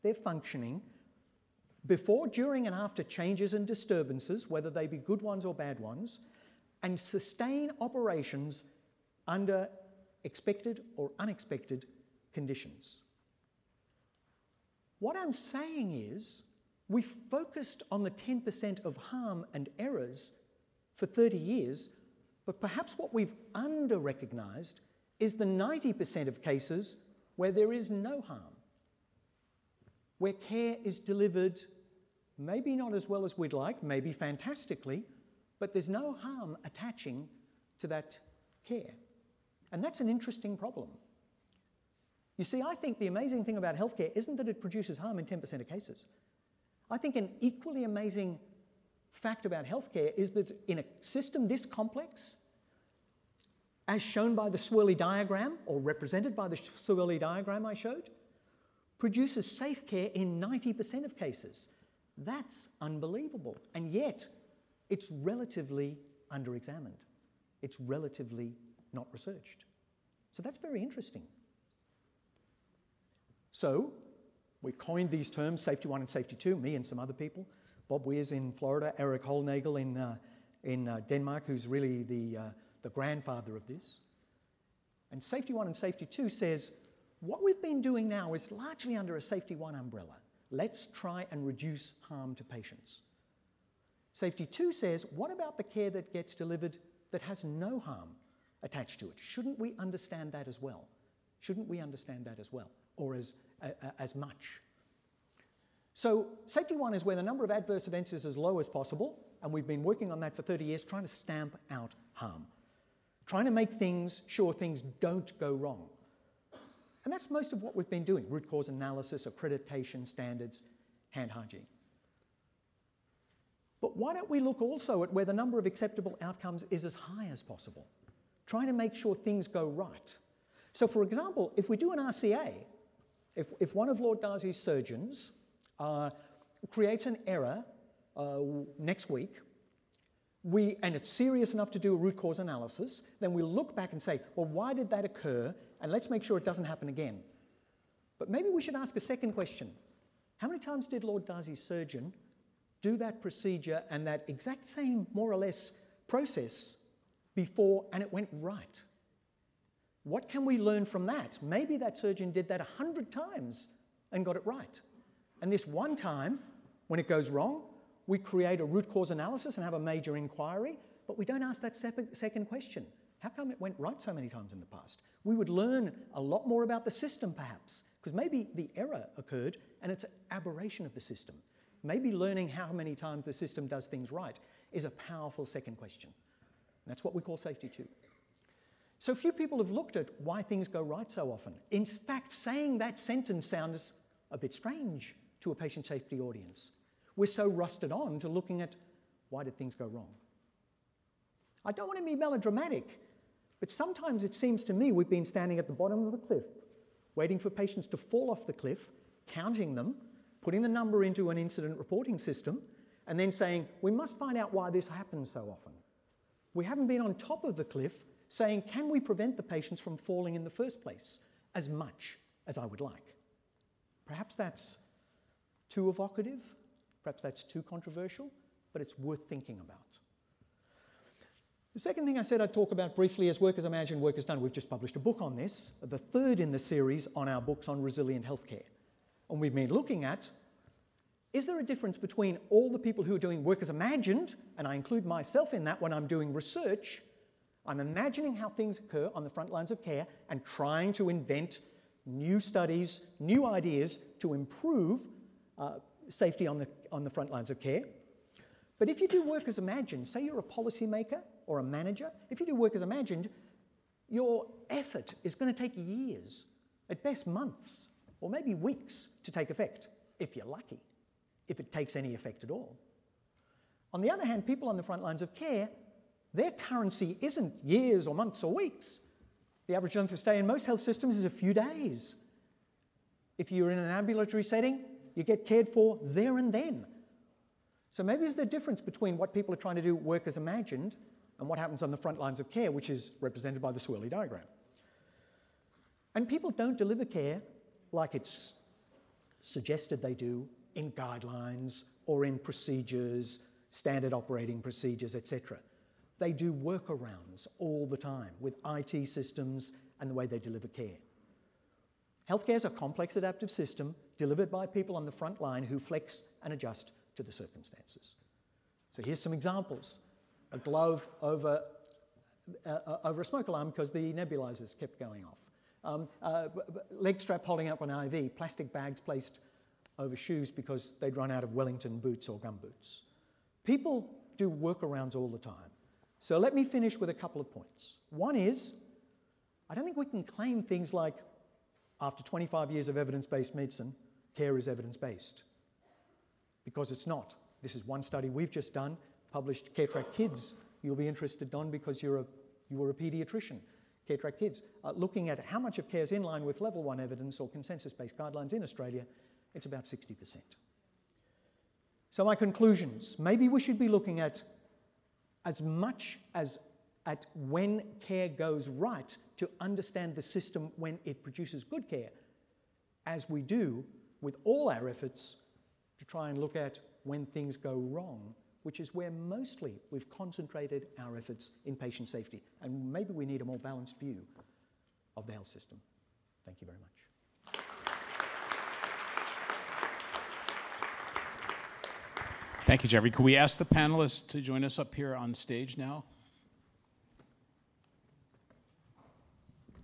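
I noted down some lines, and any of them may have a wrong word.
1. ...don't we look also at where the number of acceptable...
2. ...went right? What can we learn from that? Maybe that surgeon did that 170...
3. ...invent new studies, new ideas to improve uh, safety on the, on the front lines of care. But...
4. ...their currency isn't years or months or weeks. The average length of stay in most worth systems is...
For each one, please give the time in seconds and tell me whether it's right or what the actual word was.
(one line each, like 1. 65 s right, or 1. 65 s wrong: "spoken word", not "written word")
1. 124 s right
2. 158 s wrong: "100", not "170"
3. 251 s right
4. 276 s wrong: "health", not "worth".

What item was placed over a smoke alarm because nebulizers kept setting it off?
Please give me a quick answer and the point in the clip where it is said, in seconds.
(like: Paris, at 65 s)
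A glove, at 320 s.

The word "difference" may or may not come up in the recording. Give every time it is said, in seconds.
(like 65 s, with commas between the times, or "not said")
241 s, 288 s.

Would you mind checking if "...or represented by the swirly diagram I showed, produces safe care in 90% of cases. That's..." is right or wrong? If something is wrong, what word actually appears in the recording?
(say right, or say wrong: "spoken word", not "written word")
right.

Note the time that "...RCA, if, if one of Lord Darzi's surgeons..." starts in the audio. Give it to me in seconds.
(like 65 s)
131 s.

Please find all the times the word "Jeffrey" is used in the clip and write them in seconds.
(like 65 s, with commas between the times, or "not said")
392 s.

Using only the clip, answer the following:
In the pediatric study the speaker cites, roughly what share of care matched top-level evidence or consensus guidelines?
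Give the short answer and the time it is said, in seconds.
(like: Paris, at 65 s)
60%, at 359 s.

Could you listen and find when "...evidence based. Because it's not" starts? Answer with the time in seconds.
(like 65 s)
344 s.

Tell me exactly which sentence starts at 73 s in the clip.
So we coined these terms, safety one and safety two, me and some other people.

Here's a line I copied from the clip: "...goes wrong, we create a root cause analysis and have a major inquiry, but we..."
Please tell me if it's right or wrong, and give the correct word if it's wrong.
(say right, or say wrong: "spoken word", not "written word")
right.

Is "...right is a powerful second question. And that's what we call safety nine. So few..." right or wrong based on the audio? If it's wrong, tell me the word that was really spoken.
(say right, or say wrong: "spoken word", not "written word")
wrong: "two", not "nine".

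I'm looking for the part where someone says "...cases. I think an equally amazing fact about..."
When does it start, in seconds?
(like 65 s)
45 s.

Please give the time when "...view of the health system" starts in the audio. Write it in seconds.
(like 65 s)
383 s.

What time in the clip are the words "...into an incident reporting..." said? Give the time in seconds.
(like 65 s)
211 s.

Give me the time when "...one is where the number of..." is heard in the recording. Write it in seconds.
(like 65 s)
106 s.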